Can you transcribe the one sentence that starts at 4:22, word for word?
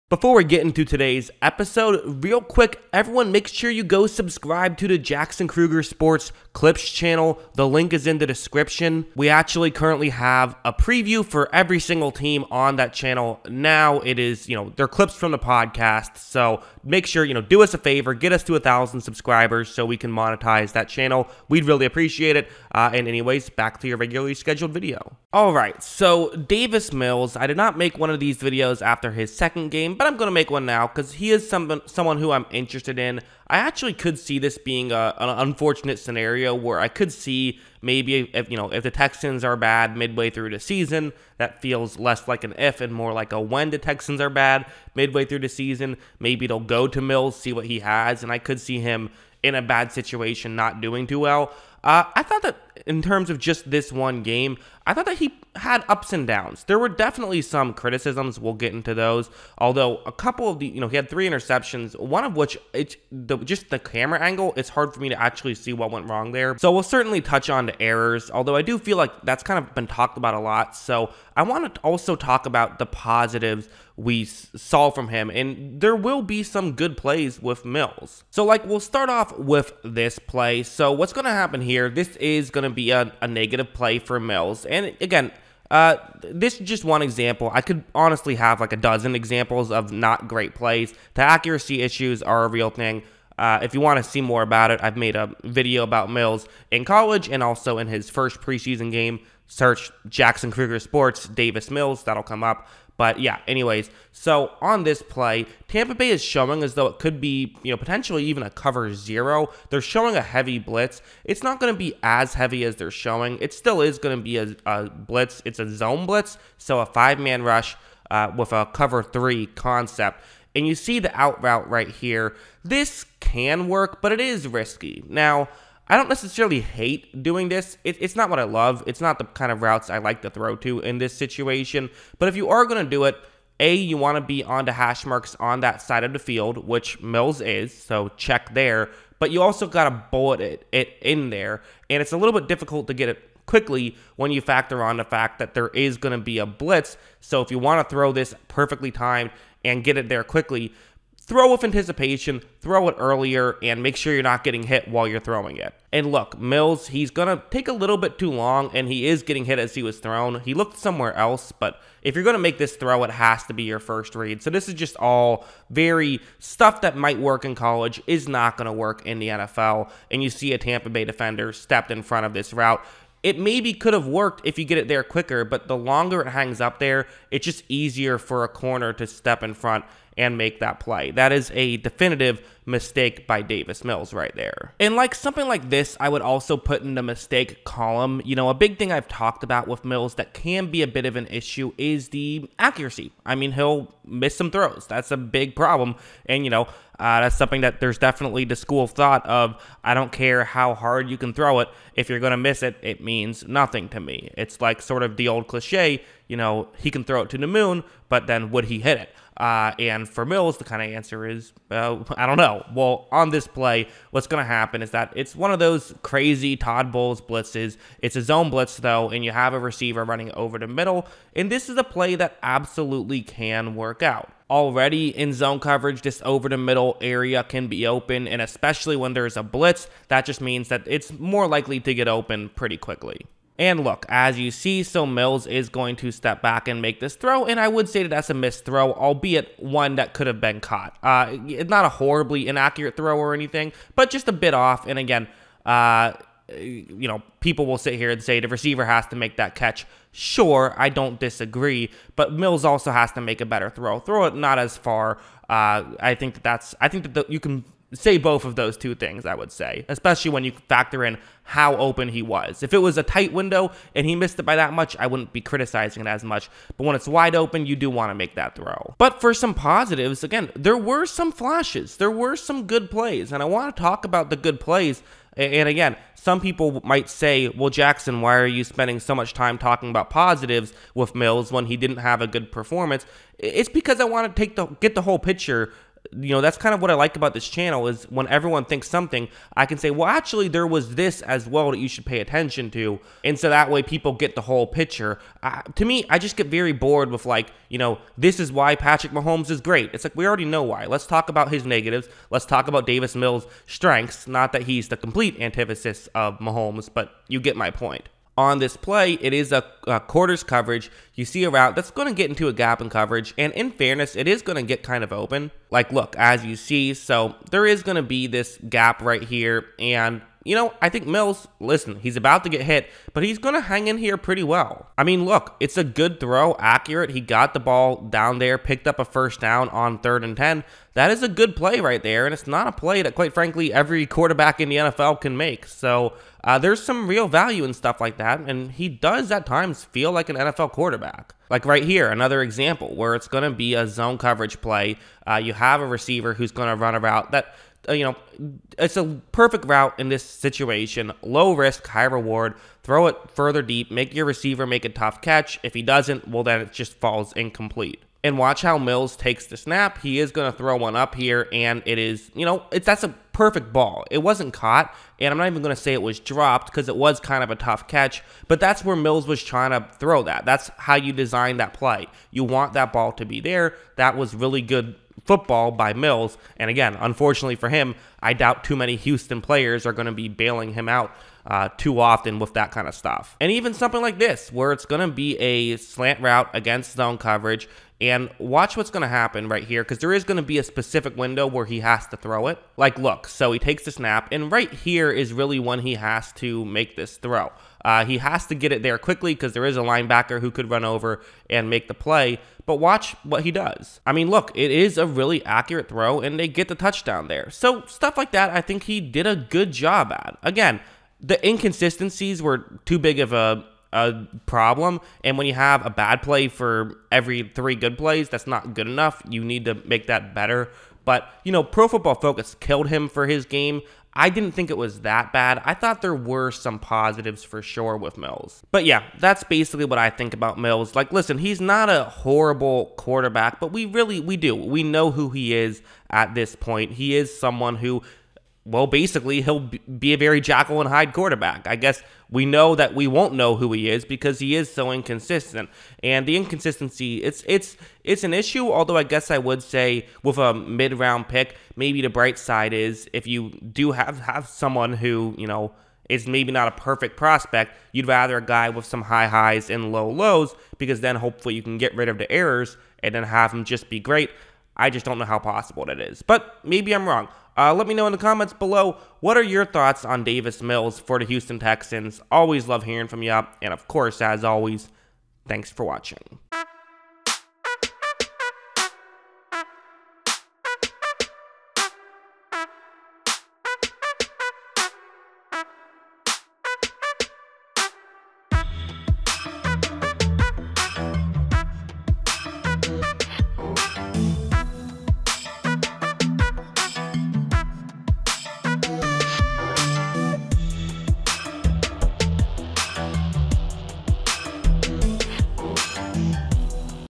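If it was a tight window and he missed it by that much, I wouldn't be criticizing it as much.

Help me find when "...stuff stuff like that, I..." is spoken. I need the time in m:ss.
6:47.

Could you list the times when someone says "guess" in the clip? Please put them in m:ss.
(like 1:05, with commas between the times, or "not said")
7:21, 7:29.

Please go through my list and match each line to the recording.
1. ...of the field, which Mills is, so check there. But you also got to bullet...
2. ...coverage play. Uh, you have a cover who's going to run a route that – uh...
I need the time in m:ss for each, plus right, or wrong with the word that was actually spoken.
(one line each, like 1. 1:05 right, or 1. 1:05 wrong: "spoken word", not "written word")
1. 2:16 right
2. 5:44 wrong: "receiver", not "cover".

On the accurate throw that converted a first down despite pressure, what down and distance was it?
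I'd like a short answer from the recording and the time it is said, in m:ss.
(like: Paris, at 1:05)
third and 10, at 5:29.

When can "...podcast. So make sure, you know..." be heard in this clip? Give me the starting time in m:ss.
0:15.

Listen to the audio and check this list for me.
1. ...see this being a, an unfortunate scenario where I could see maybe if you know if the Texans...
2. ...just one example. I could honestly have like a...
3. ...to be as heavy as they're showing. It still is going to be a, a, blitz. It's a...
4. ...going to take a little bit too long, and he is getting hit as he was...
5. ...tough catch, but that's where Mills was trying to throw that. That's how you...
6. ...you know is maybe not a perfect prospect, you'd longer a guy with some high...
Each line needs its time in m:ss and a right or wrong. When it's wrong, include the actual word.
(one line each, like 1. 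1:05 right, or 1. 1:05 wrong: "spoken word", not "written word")
1. 0:34 right
2. 1:26 right
3. 1:51 right
4. 2:37 right
5. 6:07 right
6. 7:35 wrong: "rather", not "longer".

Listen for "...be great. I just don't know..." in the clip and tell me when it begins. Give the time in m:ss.
7:43.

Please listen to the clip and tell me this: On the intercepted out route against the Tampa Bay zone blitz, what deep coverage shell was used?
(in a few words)
cover three.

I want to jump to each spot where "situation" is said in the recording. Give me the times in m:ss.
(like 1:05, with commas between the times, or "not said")
0:49, 2:11, 5:50.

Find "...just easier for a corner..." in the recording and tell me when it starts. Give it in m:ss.
2:57.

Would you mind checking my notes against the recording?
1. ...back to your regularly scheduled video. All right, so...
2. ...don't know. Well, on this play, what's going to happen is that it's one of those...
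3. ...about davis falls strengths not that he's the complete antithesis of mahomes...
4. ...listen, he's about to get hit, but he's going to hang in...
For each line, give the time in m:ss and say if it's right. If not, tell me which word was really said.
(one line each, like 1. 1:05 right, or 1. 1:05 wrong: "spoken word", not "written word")
1. 0:23 right
2. 3:32 right
3. 5:02 wrong: "mills", not "falls"
4. 5:21 right.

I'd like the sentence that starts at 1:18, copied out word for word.
So, like, we'll start off with this play.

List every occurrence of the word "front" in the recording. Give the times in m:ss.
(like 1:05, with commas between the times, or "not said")
2:52, 2:59.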